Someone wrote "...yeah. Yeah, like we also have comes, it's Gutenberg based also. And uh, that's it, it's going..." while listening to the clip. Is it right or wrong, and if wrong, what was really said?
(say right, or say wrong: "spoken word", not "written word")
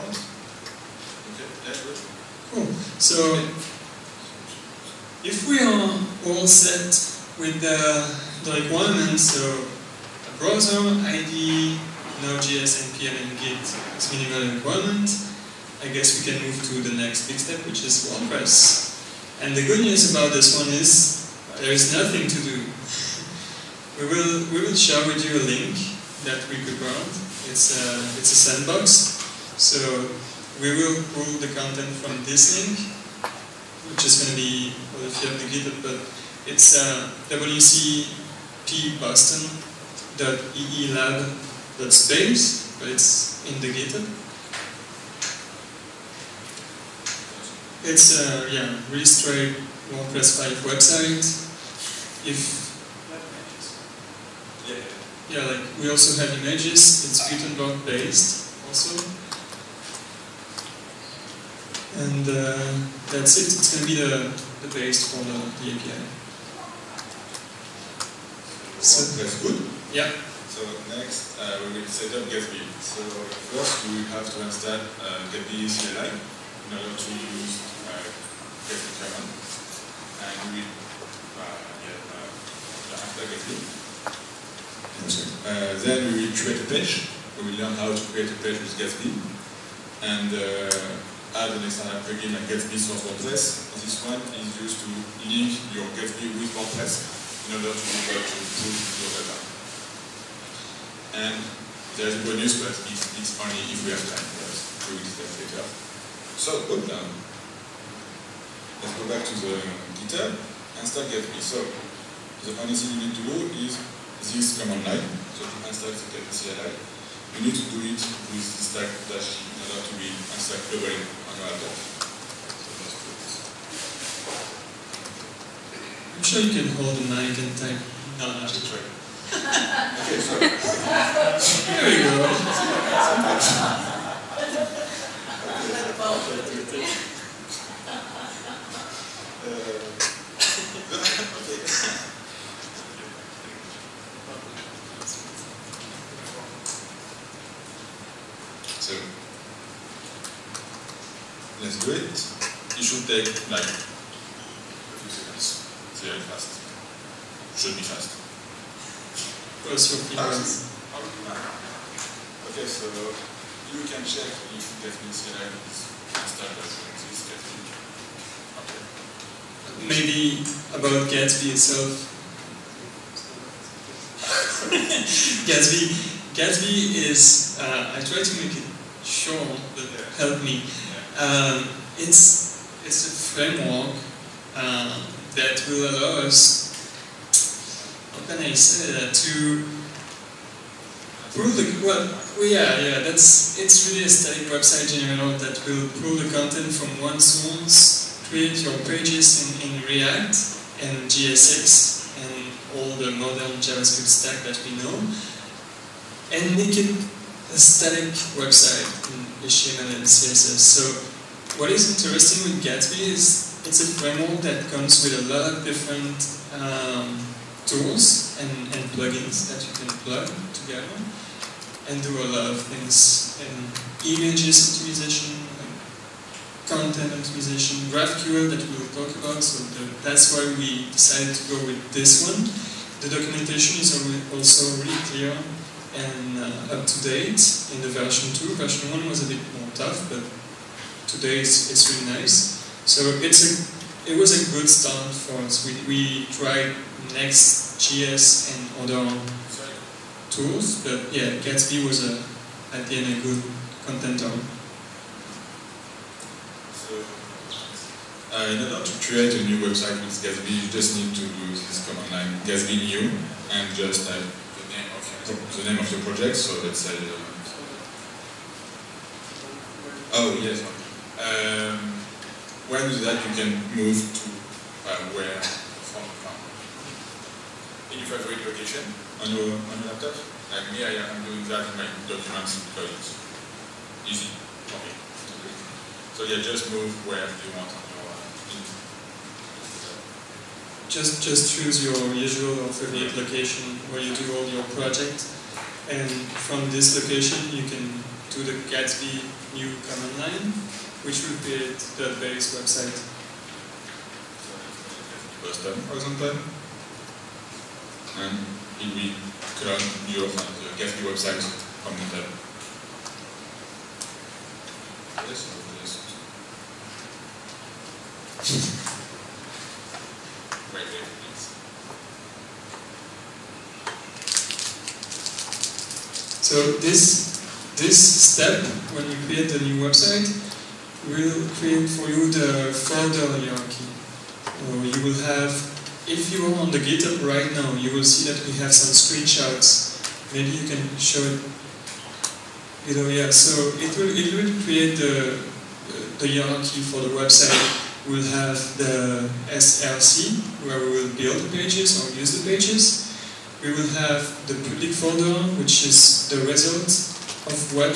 wrong: "images", not "comes".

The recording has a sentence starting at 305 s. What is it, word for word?
For example, and it will create your uh, Gatsby website on the tab.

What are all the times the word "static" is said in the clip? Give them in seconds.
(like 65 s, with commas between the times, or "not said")
194 s, 207 s.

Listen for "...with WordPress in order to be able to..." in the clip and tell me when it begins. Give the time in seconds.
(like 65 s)
96 s.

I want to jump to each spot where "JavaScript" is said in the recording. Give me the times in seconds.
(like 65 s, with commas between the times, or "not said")
203 s.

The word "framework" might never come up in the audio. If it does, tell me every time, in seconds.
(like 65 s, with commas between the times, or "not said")
183 s, 213 s.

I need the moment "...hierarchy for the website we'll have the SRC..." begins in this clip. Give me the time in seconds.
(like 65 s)
346 s.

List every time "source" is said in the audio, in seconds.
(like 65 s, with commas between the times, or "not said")
92 s, 197 s.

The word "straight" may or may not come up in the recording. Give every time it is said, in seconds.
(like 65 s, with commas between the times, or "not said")
49 s.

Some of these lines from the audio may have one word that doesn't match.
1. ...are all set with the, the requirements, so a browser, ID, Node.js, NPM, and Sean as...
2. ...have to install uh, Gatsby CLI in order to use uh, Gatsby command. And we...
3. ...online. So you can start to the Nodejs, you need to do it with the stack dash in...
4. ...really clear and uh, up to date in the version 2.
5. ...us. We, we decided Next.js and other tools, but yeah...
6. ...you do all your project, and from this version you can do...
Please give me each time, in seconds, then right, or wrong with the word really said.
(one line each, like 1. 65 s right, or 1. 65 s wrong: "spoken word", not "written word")
1. 5 s wrong: "Git", not "Sean"
2. 74 s right
3. 114 s wrong: "CLI", not "Nodejs"
4. 234 s right
5. 245 s wrong: "tried", not "decided"
6. 293 s wrong: "location", not "version".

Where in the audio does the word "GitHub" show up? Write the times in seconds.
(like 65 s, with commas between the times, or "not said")
35 s, 43 s, 110 s, 336 s.